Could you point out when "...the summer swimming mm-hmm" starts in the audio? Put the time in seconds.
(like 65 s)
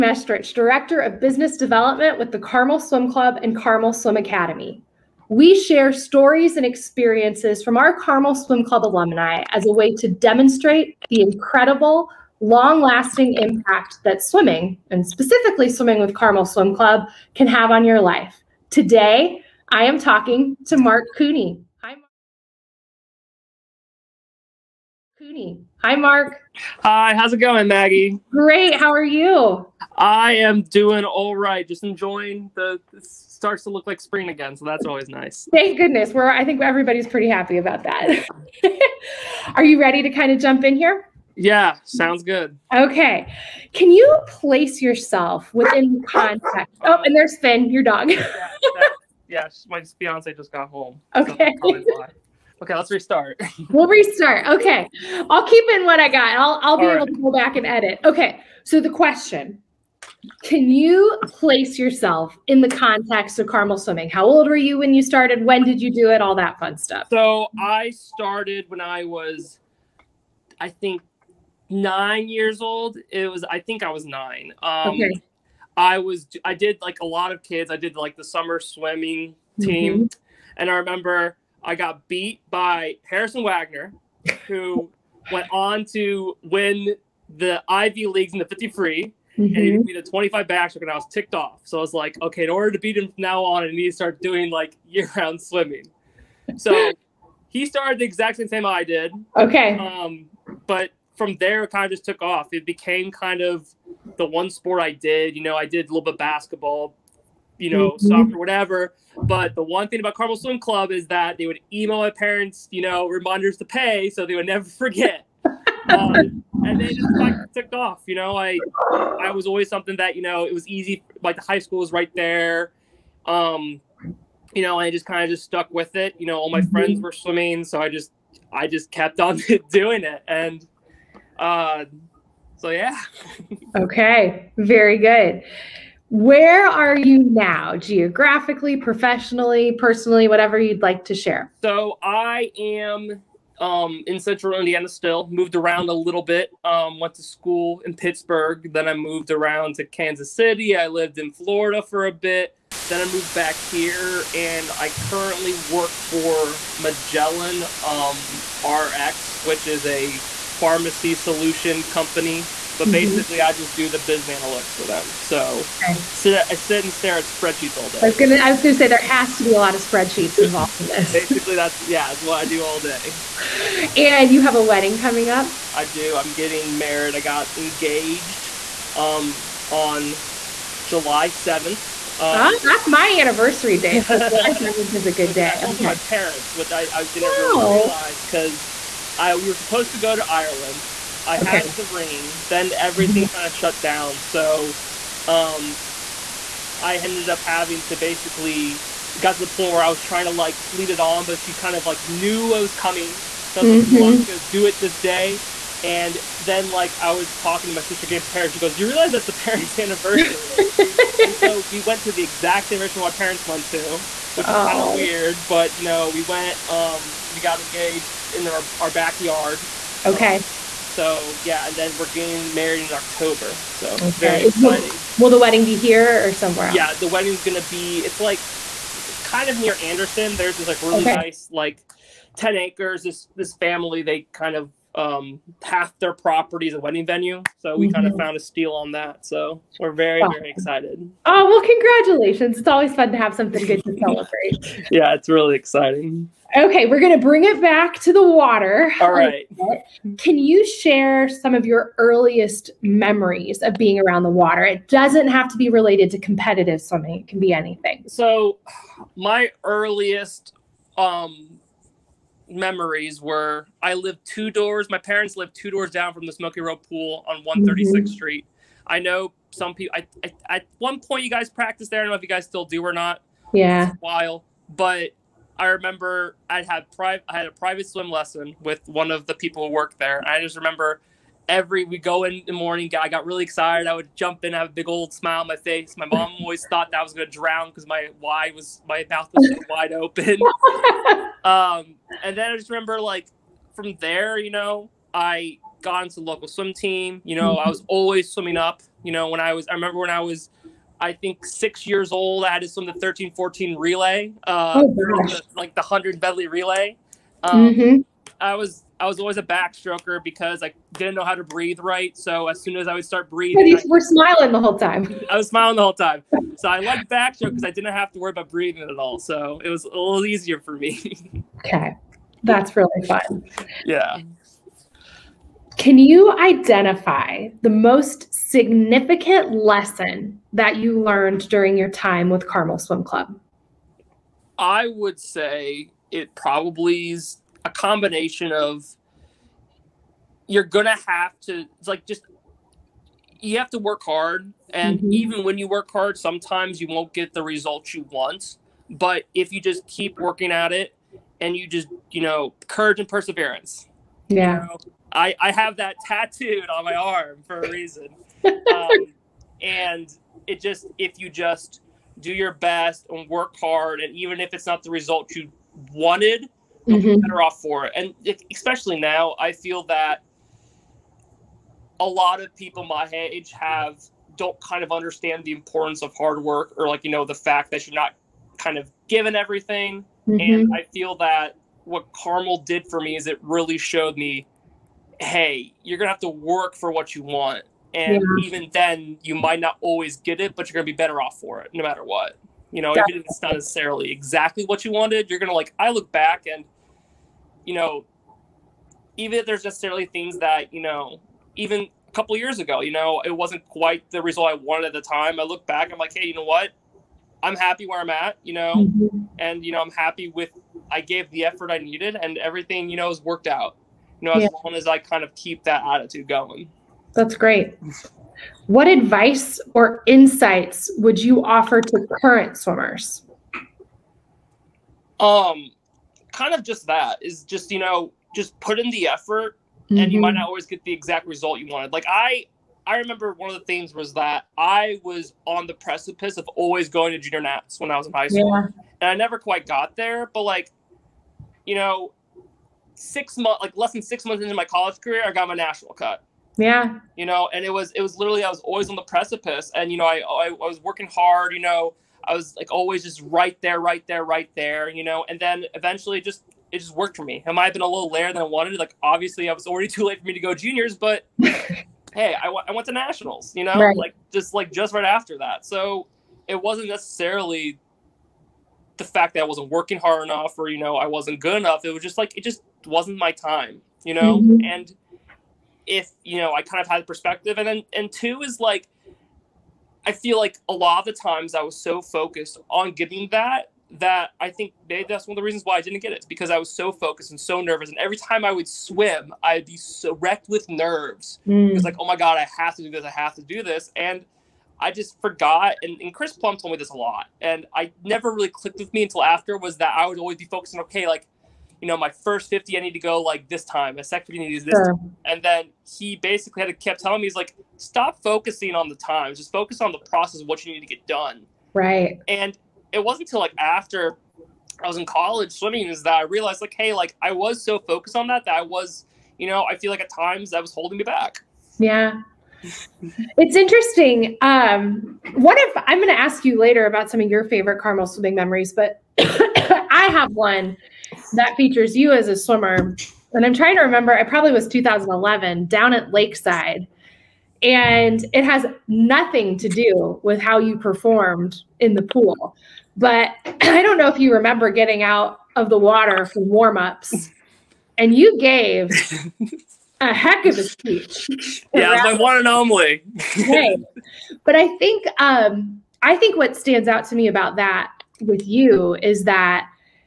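78 s.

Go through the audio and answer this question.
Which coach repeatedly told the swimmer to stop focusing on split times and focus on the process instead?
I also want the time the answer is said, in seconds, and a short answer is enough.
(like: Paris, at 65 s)
Chris Plumb, at 496 s.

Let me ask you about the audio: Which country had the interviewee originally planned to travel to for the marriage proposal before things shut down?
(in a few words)
Ireland.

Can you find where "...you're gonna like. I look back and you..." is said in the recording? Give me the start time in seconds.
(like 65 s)
395 s.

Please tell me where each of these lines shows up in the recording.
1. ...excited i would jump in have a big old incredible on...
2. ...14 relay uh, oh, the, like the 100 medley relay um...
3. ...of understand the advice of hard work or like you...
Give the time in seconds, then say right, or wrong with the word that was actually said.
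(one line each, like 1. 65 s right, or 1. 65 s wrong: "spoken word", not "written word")
1. 283 s wrong: "smile", not "incredible"
2. 303 s right
3. 374 s wrong: "importance", not "advice".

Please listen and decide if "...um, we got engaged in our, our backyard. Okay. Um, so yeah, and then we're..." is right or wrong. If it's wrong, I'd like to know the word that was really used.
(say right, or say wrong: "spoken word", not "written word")
right.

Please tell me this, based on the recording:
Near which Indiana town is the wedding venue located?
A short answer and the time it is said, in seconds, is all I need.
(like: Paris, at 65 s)
Anderson, at 229 s.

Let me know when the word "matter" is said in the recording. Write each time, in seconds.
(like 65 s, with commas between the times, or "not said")
391 s.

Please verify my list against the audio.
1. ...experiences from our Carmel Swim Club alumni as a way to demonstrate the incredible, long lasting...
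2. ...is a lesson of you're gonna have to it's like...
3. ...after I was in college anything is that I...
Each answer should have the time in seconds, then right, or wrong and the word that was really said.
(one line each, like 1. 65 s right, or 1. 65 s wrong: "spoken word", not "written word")
1. 6 s right
2. 337 s wrong: "combination", not "lesson"
3. 513 s wrong: "swimming", not "anything".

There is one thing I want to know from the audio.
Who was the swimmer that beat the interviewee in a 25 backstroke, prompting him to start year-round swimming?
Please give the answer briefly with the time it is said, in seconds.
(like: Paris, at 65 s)
Harrison Wagner, at 83 s.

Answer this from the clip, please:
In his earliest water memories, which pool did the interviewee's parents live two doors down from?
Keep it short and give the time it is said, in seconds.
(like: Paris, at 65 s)
Smokey Row pool, at 266 s.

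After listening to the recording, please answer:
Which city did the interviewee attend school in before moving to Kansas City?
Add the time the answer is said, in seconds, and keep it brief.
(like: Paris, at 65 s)
Pittsburgh, at 147 s.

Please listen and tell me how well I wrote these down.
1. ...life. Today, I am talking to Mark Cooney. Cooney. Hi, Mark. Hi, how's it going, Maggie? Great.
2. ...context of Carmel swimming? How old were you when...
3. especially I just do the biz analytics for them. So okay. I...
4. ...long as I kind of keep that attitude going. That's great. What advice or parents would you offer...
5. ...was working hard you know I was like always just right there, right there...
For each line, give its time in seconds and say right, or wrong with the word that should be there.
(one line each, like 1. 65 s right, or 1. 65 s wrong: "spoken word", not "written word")
1. 17 s right
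2. 62 s right
3. 162 s wrong: "basically", not "especially"
4. 414 s wrong: "insights", not "parents"
5. 450 s right.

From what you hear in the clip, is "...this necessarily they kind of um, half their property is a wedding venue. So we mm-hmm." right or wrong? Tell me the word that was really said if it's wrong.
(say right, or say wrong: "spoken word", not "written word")
wrong: "family", not "necessarily".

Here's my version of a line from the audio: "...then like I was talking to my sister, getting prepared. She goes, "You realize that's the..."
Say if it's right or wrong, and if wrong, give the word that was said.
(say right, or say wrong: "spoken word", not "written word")
right.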